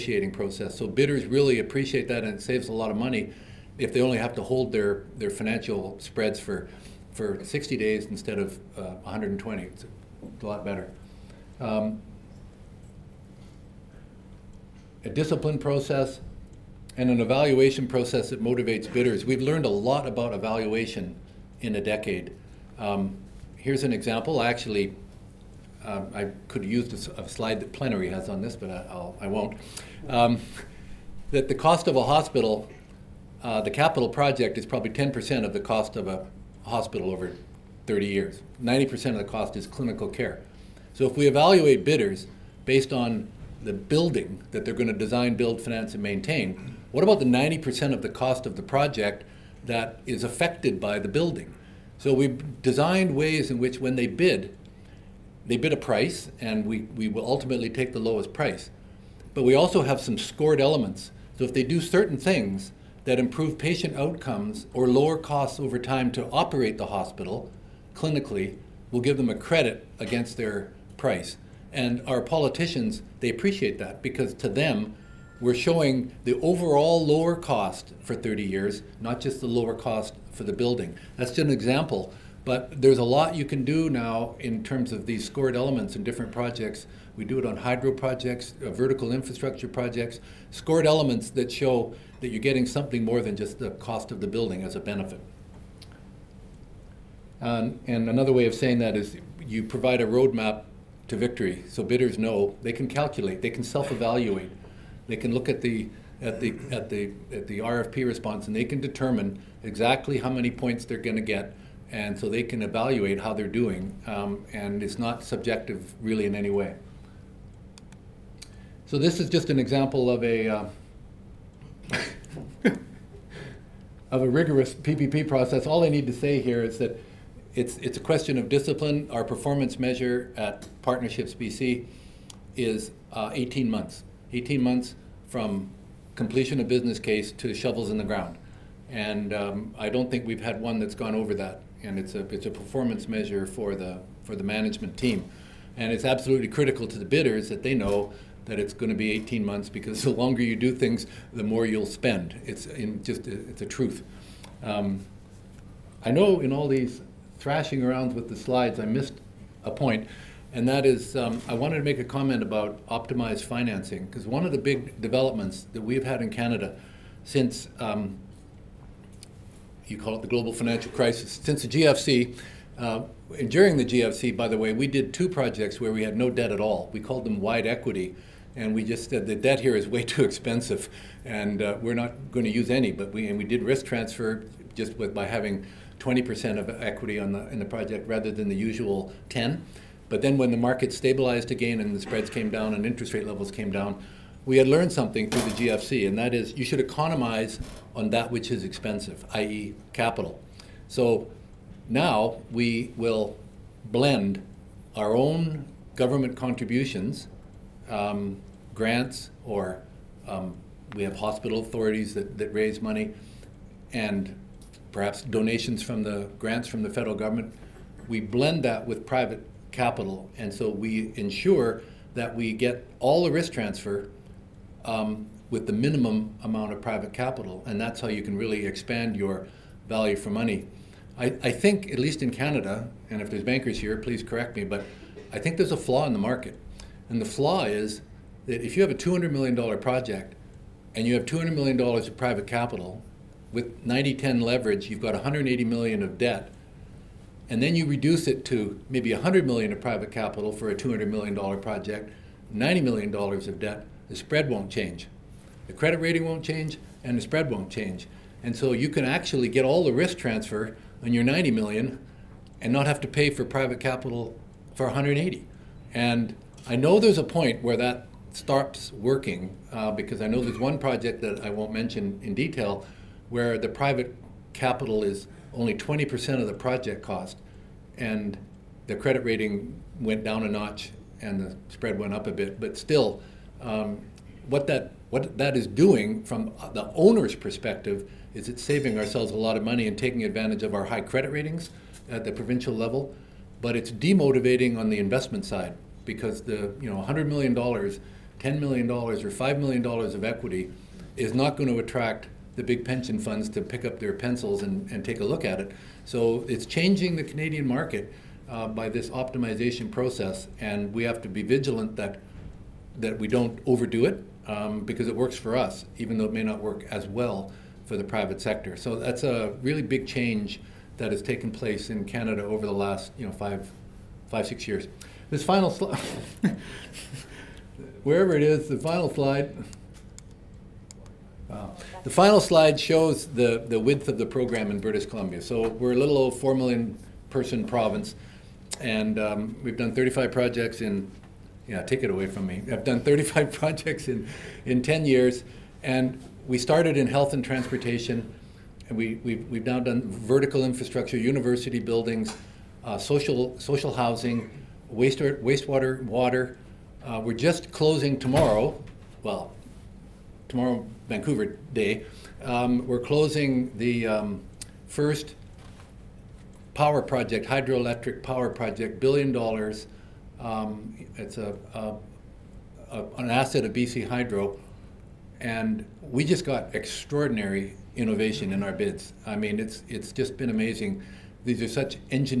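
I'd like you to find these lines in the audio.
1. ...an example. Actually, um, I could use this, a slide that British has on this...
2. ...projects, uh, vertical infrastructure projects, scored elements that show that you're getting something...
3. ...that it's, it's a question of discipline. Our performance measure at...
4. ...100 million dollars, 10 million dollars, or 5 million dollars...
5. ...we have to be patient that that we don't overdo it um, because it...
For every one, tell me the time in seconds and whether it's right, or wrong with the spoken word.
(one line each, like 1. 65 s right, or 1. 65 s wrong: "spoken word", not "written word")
1. 23 s wrong: "Plenary", not "British"
2. 87 s right
3. 126 s right
4. 296 s right
5. 310 s wrong: "vigilant", not "patient".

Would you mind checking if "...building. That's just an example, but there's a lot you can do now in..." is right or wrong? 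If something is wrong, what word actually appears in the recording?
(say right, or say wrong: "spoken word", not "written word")
right.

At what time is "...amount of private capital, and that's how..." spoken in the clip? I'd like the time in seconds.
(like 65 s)
226 s.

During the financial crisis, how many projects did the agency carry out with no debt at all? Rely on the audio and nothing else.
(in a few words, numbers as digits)
2.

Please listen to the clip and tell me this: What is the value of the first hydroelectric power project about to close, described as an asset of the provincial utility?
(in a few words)
1 billion dollars.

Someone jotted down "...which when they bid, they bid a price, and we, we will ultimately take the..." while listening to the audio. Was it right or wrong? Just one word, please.
right.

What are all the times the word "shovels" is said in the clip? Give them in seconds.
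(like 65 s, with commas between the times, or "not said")
137 s.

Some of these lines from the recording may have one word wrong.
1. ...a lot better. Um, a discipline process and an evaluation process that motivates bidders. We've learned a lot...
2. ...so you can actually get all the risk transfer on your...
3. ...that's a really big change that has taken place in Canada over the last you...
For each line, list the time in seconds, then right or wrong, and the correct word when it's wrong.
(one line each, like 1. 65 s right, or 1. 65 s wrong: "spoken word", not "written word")
1. 10 s right
2. 258 s right
3. 318 s right.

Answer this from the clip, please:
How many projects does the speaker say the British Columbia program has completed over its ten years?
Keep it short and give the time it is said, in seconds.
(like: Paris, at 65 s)
35, at 339 s.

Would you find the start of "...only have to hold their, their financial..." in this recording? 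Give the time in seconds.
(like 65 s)
4 s.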